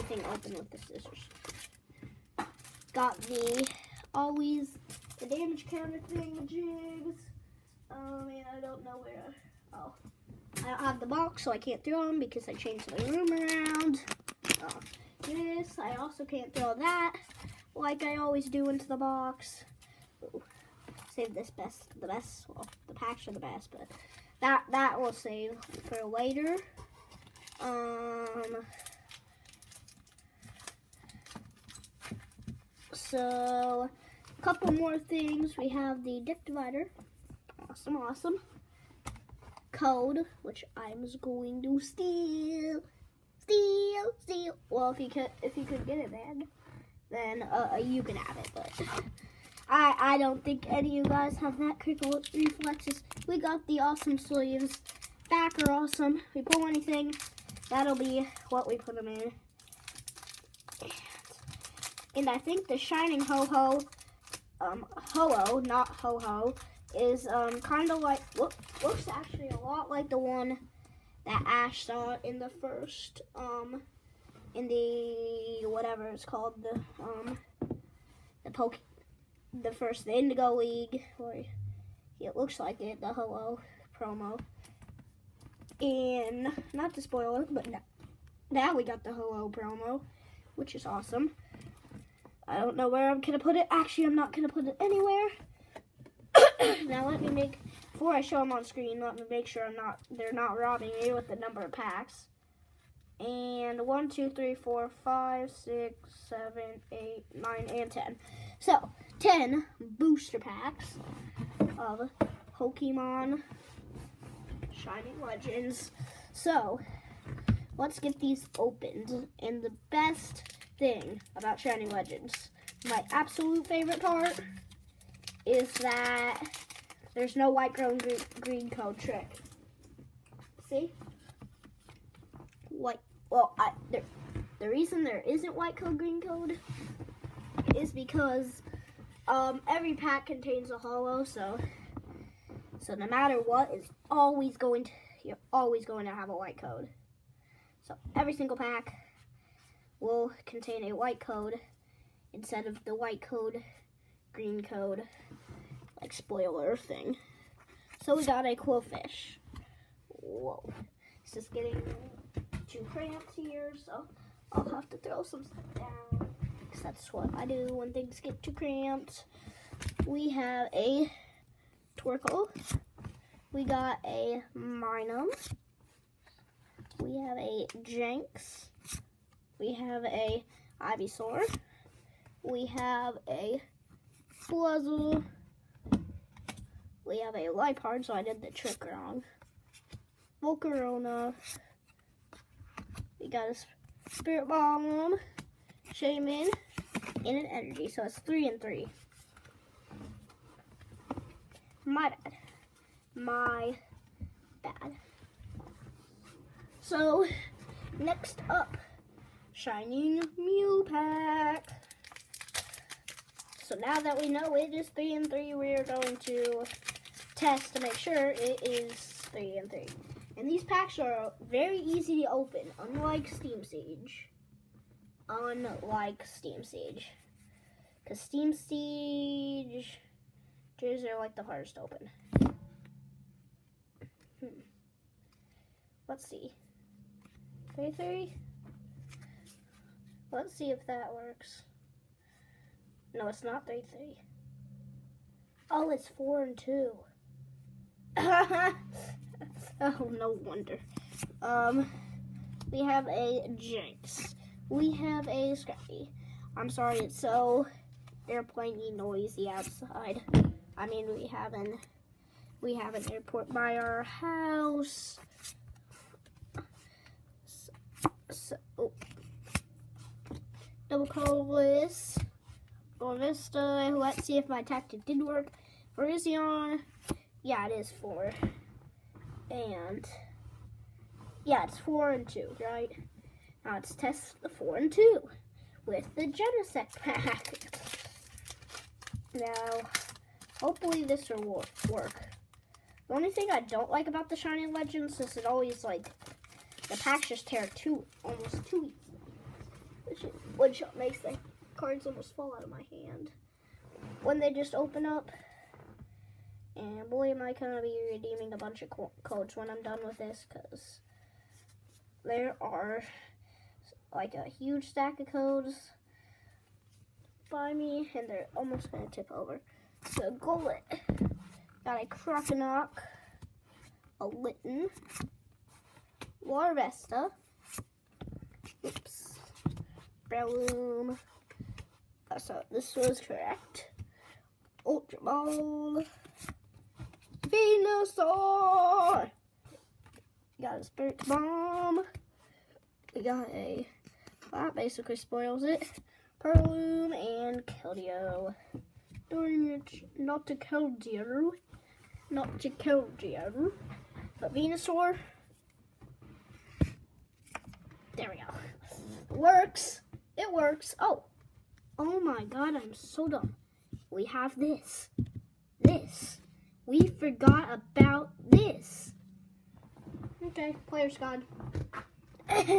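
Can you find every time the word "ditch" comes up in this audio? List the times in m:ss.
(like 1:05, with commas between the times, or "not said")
not said.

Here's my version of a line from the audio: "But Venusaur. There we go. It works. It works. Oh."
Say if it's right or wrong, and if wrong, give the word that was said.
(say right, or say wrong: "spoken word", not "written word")
right.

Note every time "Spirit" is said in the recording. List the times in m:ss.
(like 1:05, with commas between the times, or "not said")
3:14, 5:40.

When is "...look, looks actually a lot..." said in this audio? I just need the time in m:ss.
1:08.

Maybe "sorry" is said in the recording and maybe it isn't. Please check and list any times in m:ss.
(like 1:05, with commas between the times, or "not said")
4:16.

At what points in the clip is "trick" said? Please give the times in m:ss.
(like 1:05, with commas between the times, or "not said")
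2:08, 3:08.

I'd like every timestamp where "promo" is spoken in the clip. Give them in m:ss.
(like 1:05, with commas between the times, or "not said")
1:23, 1:29.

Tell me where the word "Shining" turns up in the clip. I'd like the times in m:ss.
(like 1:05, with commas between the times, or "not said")
1:02, 1:54, 2:01, 3:29, 4:54.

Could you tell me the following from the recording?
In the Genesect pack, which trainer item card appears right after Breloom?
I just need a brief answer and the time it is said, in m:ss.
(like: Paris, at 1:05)
Ultra Ball, at 5:34.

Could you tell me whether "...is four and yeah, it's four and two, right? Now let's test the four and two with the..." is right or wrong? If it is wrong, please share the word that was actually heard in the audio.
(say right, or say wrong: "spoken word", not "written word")
right.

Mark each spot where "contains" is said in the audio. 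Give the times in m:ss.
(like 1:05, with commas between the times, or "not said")
2:20, 2:30.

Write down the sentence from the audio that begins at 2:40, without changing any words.
Whoa, it's just getting two cramps here, so I'll have to throw some stuff down.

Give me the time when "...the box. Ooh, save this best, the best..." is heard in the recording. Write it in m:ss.
0:18.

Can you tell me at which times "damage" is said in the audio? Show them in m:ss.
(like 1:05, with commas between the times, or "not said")
0:05.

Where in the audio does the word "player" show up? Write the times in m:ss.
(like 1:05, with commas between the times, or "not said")
6:10.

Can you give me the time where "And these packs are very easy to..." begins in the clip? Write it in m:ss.
3:40.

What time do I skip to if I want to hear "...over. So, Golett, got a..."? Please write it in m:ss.
5:19.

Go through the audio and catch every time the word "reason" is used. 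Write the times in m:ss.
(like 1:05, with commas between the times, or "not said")
2:14.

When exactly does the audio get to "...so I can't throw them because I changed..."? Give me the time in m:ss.
0:11.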